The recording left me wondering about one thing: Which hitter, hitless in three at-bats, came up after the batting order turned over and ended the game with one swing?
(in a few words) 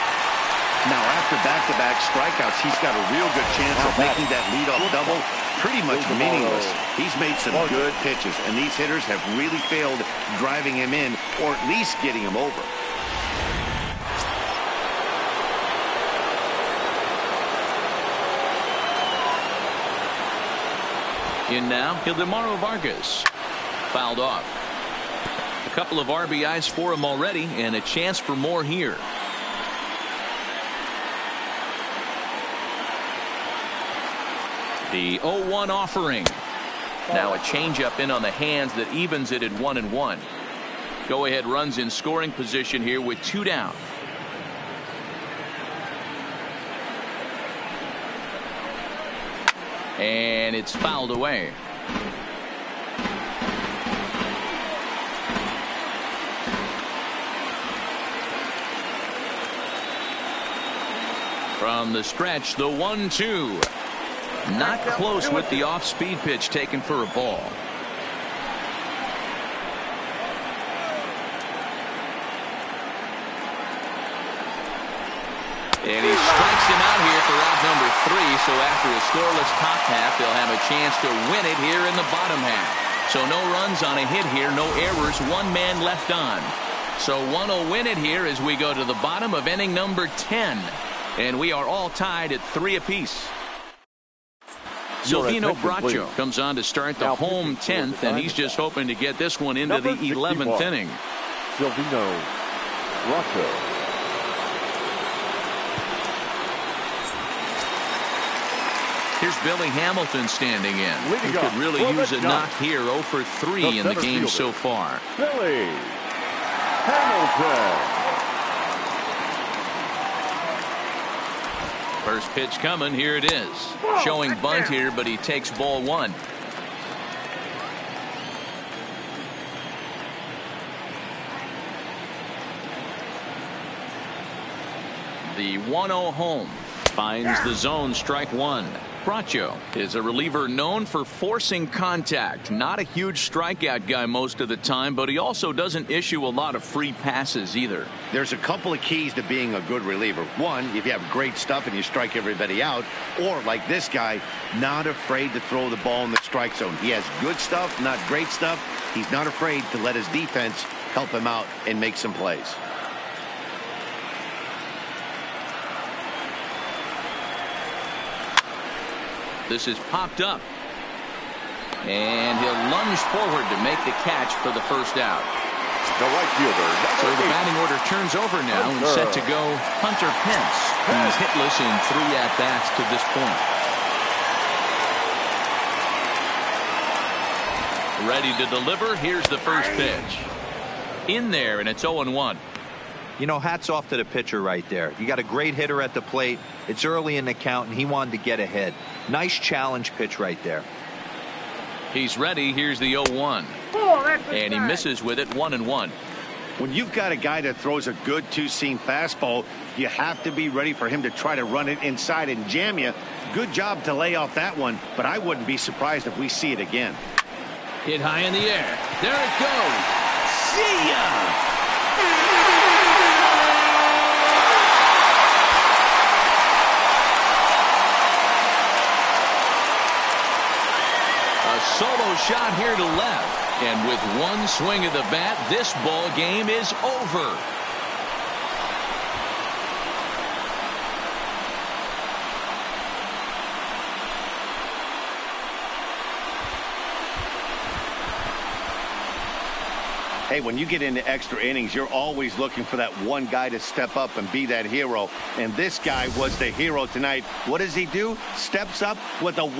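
Hunter Pence.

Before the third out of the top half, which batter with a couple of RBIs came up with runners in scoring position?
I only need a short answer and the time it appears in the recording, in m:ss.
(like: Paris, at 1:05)
Ildemaro Vargas, at 0:22.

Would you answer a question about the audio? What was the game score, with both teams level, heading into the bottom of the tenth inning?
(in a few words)
3 apiece.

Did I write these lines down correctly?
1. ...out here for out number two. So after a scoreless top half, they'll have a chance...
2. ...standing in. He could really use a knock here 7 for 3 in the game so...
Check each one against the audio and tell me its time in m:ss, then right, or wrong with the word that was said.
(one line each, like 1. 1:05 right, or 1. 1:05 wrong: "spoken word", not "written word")
1. 1:16 wrong: "three", not "two"
2. 1:50 wrong: "0", not "7".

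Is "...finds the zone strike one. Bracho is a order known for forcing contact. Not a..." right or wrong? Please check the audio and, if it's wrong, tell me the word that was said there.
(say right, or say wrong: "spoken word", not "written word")
wrong: "reliever", not "order".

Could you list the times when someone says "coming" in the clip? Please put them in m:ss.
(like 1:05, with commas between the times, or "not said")
2:02.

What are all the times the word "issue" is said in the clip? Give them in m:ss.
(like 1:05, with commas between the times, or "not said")
2:25.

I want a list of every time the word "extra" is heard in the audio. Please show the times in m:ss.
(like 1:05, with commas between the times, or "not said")
4:11.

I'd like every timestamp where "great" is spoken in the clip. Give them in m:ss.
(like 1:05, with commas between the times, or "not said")
2:31, 2:38, 3:15.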